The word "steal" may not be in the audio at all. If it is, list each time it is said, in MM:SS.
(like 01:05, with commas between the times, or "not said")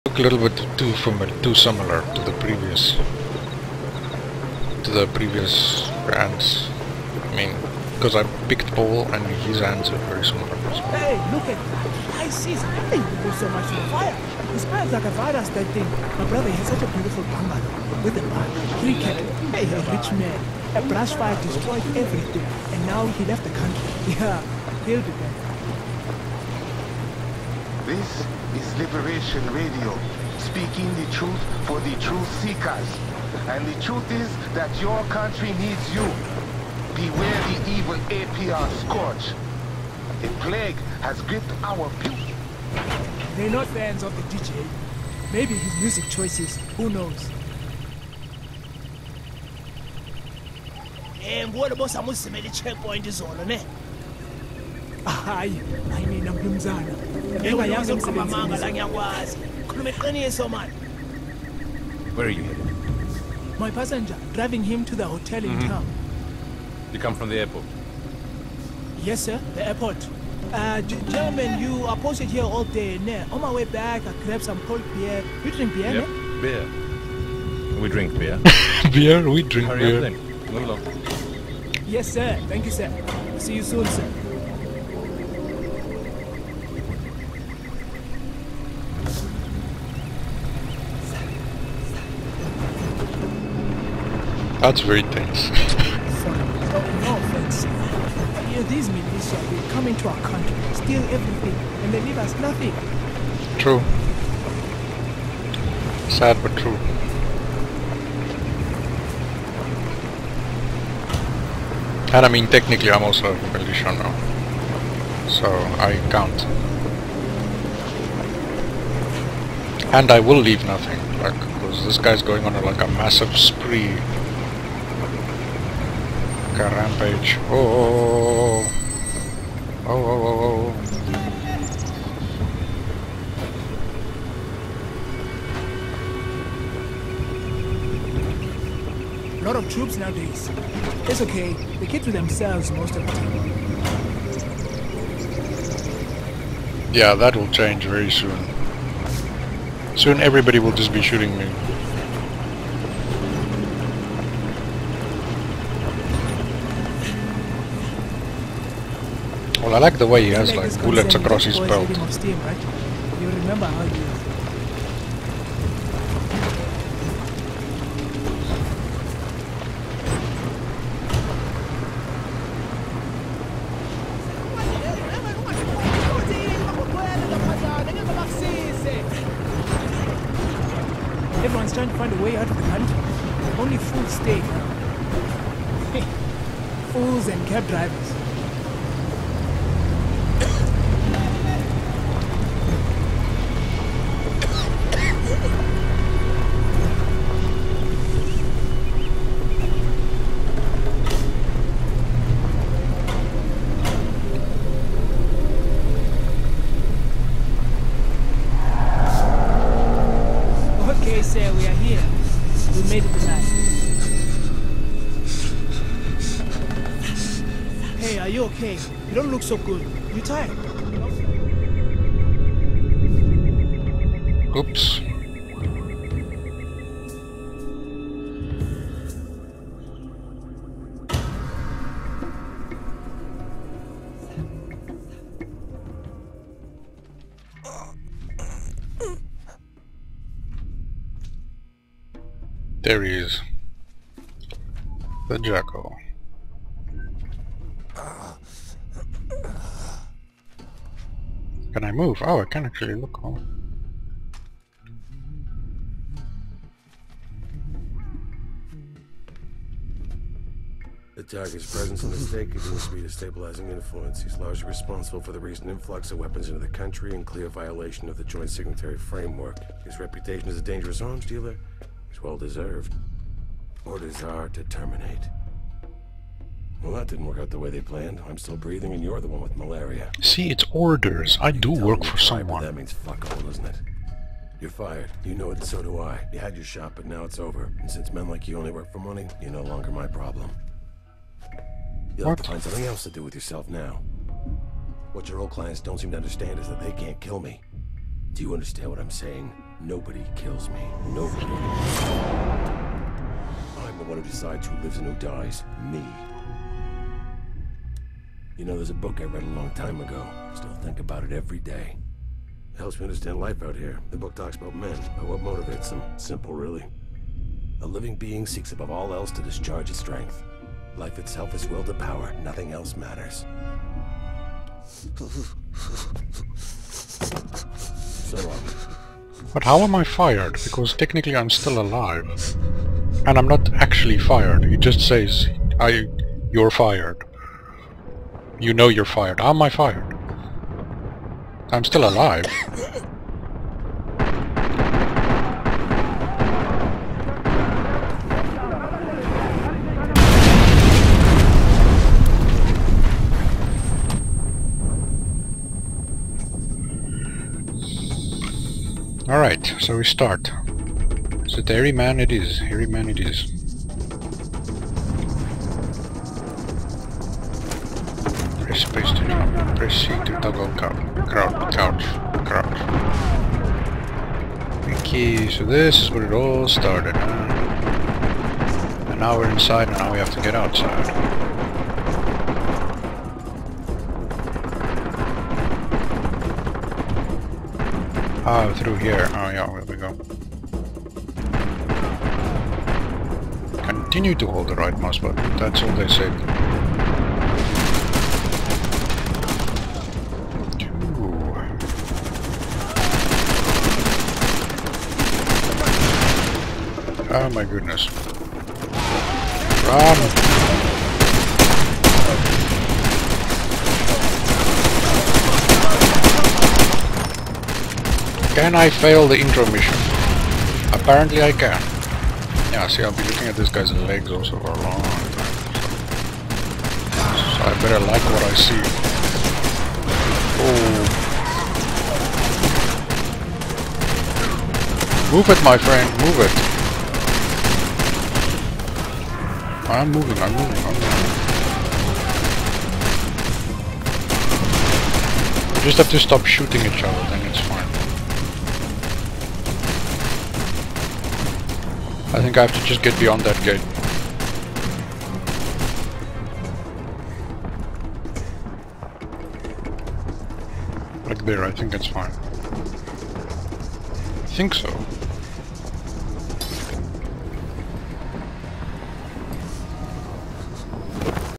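01:40.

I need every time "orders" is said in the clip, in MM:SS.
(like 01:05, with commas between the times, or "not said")
04:33, 04:40.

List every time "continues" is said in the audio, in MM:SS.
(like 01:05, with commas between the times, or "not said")
04:22, 06:33.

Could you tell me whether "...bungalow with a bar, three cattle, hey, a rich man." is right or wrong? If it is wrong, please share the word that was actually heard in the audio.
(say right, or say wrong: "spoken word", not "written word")
right.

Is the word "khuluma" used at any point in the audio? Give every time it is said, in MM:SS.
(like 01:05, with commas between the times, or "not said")
00:59.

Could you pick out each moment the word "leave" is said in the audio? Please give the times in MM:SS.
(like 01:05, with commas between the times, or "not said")
01:42, 02:00.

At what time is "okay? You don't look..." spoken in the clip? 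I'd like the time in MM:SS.
03:38.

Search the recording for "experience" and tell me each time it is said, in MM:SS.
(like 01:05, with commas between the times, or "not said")
not said.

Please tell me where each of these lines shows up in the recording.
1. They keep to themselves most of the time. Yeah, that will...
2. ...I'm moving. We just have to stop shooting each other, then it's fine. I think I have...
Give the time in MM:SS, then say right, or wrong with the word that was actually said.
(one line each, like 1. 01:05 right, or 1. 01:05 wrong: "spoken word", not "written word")
1. 02:21 right
2. 07:20 right.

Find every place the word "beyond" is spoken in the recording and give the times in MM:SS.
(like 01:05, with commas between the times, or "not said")
07:33.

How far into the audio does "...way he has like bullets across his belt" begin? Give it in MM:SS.
02:40.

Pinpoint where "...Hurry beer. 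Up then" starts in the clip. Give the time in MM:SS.
01:19.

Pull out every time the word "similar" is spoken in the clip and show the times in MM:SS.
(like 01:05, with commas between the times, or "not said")
00:01, 00:10.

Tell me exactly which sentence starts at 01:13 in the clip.
Ne, on my way back, I grabbed some cold beer.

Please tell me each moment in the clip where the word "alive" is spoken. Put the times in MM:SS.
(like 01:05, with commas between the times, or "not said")
05:31, 05:42.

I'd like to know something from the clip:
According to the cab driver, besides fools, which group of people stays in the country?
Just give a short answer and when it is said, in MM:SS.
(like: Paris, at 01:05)
cab drivers, at 03:07.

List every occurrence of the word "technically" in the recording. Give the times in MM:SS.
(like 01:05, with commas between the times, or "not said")
01:52, 05:30.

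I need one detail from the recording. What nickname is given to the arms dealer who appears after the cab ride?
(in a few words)
The Jackal.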